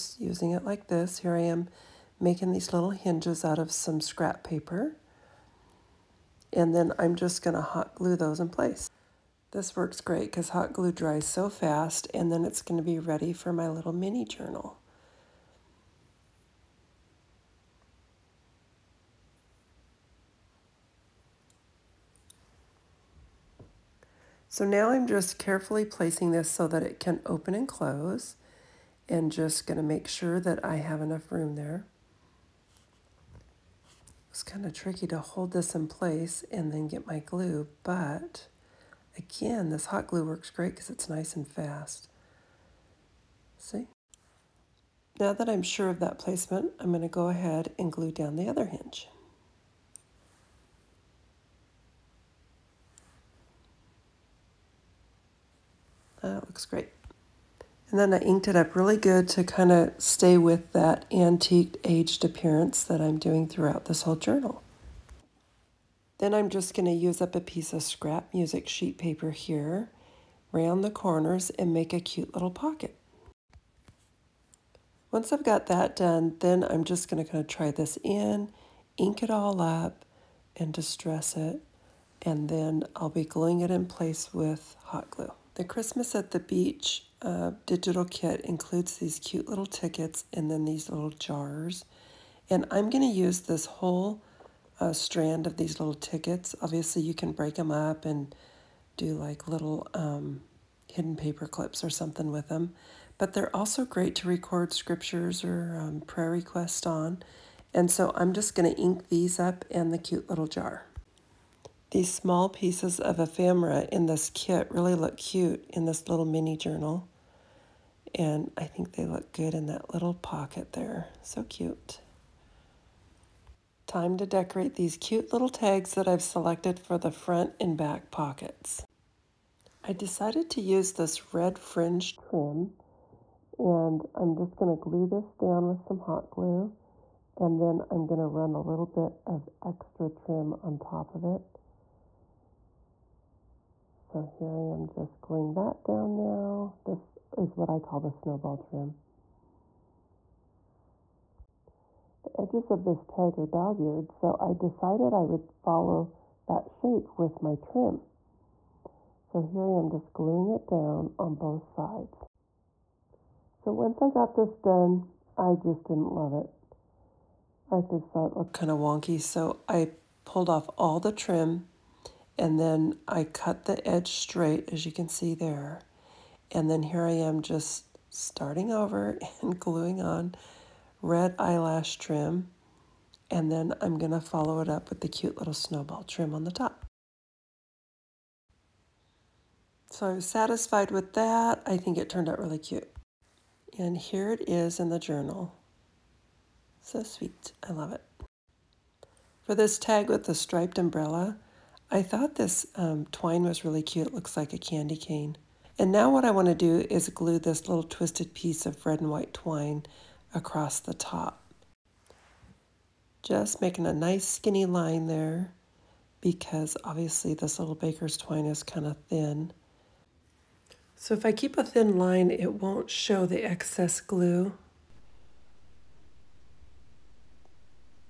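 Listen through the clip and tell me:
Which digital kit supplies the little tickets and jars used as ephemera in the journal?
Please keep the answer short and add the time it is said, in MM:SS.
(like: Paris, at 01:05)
Christmas at the Beach, at 01:25.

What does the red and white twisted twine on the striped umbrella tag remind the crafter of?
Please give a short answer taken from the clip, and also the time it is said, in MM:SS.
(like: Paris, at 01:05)
A candy cane, at 03:24.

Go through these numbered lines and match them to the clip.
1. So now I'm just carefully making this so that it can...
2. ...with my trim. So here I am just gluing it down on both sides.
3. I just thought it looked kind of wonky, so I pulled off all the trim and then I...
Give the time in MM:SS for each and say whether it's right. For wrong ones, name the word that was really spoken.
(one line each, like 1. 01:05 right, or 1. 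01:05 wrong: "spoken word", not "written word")
1. 00:24 wrong: "placing", not "making"
2. 02:37 right
3. 02:47 right.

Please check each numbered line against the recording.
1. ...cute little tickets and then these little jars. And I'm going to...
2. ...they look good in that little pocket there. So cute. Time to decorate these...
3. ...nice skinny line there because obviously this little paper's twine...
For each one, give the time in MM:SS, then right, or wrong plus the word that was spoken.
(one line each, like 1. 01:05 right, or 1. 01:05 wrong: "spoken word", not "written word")
1. 01:29 right
2. 01:58 right
3. 03:33 wrong: "baker", not "paper".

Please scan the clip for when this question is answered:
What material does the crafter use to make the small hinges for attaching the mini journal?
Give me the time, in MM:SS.
00:04.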